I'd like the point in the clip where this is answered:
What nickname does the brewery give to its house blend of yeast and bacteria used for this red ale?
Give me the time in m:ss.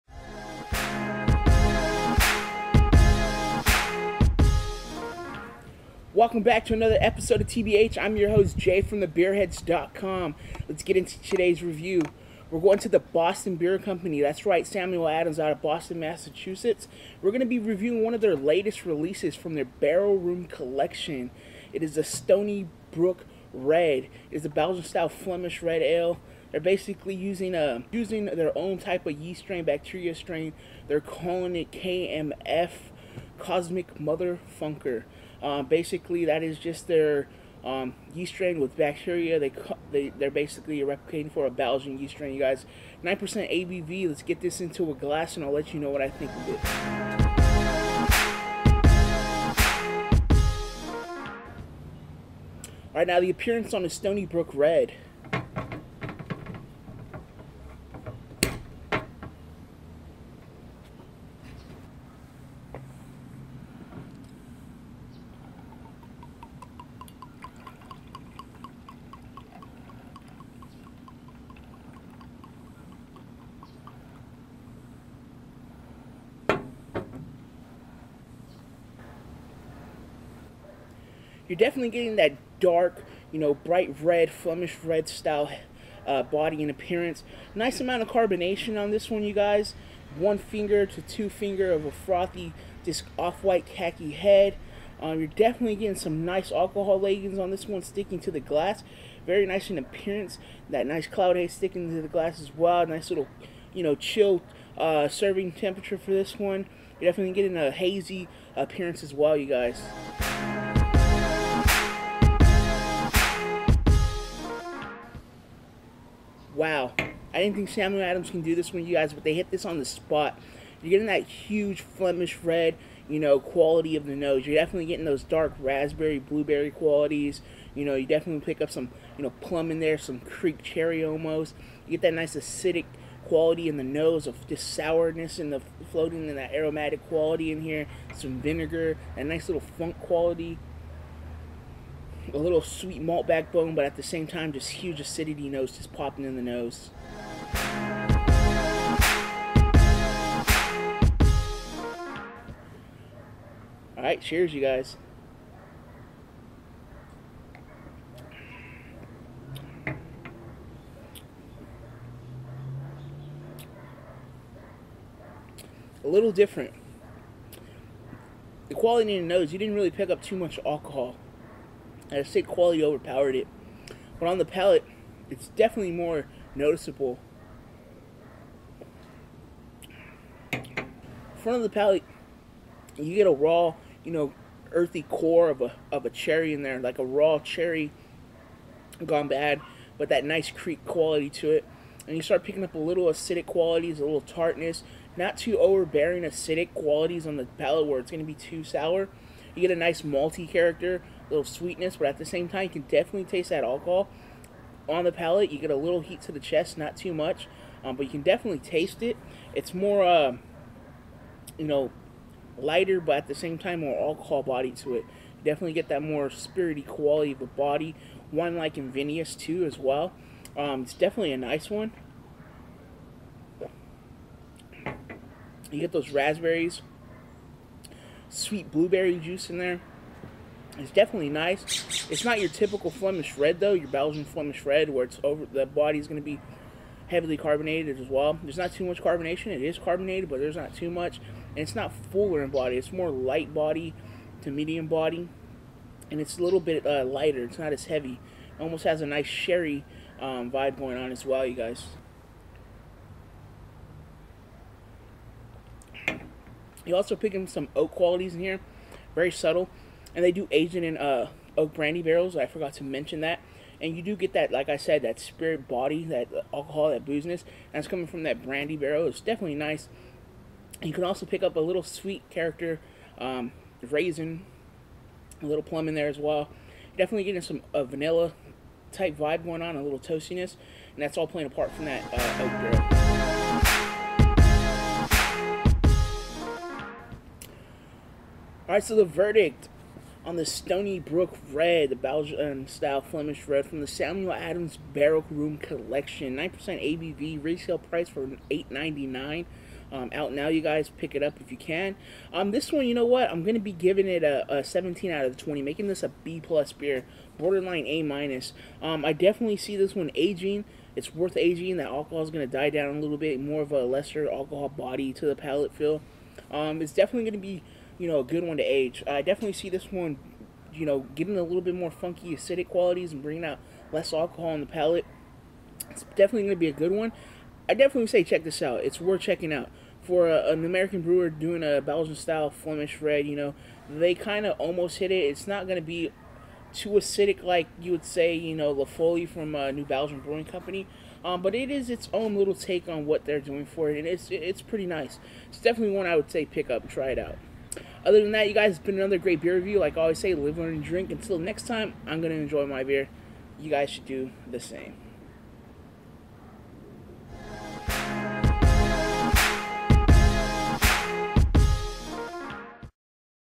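0:33.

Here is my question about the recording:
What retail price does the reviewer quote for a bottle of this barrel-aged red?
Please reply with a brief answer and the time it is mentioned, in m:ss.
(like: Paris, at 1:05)
$8.99, at 4:58.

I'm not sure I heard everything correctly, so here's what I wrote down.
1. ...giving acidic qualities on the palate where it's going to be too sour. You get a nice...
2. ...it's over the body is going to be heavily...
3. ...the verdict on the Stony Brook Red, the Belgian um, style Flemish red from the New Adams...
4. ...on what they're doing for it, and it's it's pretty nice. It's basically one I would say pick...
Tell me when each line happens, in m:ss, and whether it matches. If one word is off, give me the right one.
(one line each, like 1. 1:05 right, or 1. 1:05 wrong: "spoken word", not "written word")
1. 3:15 wrong: "overbearing", not "giving"
2. 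3:55 right
3. 4:48 wrong: "Samuel", not "New"
4. 5:42 wrong: "definitely", not "basically".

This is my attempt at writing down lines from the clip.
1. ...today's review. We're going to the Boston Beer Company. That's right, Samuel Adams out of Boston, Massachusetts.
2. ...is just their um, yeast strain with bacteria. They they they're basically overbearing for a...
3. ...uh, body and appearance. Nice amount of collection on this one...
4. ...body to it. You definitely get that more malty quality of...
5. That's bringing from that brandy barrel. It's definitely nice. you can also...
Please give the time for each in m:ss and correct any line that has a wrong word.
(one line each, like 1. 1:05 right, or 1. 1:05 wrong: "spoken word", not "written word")
1. 0:11 right
2. 0:36 wrong: "replicating", not "overbearing"
3. 1:26 wrong: "carbonation", not "collection"
4. 3:34 wrong: "spirity", not "malty"
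5. 4:27 wrong: "coming", not "bringing".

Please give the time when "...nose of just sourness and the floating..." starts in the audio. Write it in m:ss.
2:13.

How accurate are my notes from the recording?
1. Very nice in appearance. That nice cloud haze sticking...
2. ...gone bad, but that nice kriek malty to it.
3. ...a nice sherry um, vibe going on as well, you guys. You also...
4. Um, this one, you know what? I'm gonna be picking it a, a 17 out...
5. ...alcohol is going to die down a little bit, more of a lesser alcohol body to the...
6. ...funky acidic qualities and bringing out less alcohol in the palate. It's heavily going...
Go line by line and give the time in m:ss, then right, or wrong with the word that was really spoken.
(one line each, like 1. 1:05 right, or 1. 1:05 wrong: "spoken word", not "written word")
1. 1:39 right
2. 3:09 wrong: "quality", not "malty"
3. 4:09 right
4. 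5:02 wrong: "giving", not "picking"
5. 5:11 right
6. 5:21 wrong: "definitely", not "heavily".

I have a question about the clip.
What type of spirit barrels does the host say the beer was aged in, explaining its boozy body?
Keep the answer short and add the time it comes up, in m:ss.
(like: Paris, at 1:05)
brandy barrels, at 4:21.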